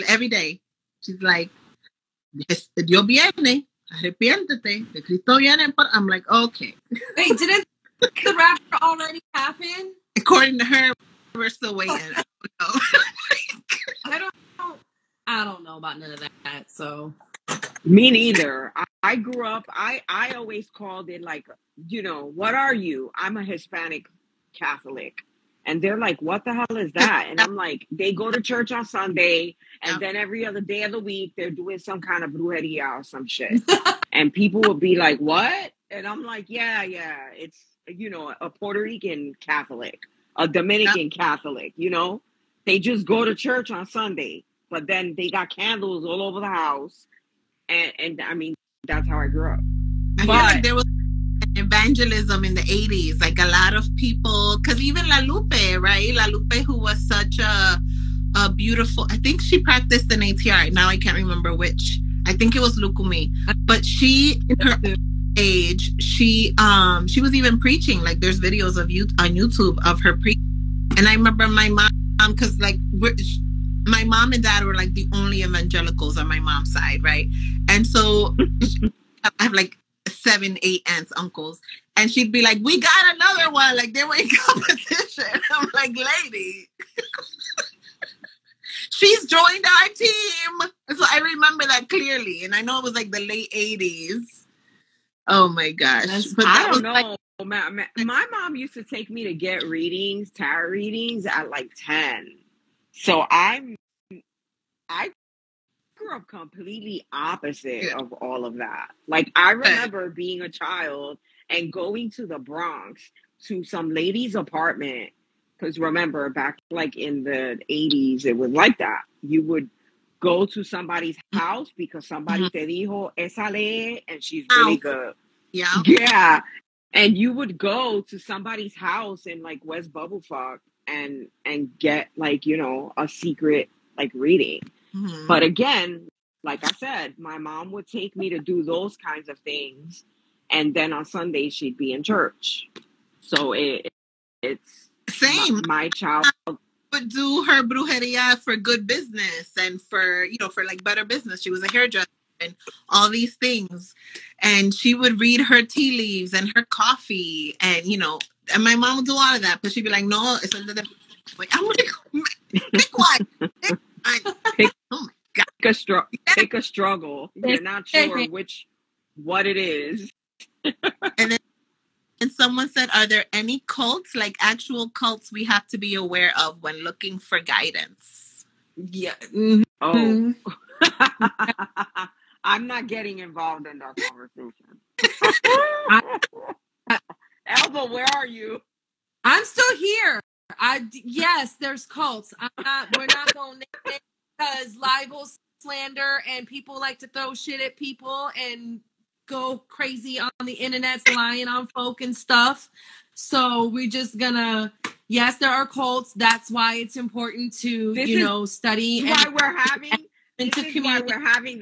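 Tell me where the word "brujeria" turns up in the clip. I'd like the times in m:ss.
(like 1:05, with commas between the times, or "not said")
0:32, 2:27.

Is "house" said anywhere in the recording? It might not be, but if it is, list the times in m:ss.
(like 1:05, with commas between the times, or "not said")
0:46, 2:01, 2:08.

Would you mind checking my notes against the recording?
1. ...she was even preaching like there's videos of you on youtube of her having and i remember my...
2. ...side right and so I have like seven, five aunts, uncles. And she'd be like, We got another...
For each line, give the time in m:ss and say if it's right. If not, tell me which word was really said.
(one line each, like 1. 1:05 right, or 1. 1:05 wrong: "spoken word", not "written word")
1. 1:07 wrong: "preaching", not "having"
2. 1:16 wrong: "eight", not "five".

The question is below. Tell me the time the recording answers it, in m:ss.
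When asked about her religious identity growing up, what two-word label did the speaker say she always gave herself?
0:23.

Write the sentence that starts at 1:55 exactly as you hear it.
Because remember, back like in the 80s, it was like that.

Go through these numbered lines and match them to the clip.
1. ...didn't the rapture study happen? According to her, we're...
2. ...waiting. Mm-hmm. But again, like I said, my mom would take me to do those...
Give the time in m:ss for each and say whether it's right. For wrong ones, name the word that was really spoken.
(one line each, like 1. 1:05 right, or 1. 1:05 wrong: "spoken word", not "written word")
1. 0:07 wrong: "already", not "study"
2. 2:14 wrong: "reading", not "waiting".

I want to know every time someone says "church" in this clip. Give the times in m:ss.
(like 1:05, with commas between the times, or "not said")
0:28, 0:43, 2:22.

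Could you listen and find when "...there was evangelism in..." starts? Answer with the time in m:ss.
0:50.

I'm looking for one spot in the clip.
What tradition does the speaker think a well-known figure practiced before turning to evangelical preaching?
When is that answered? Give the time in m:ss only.
1:02.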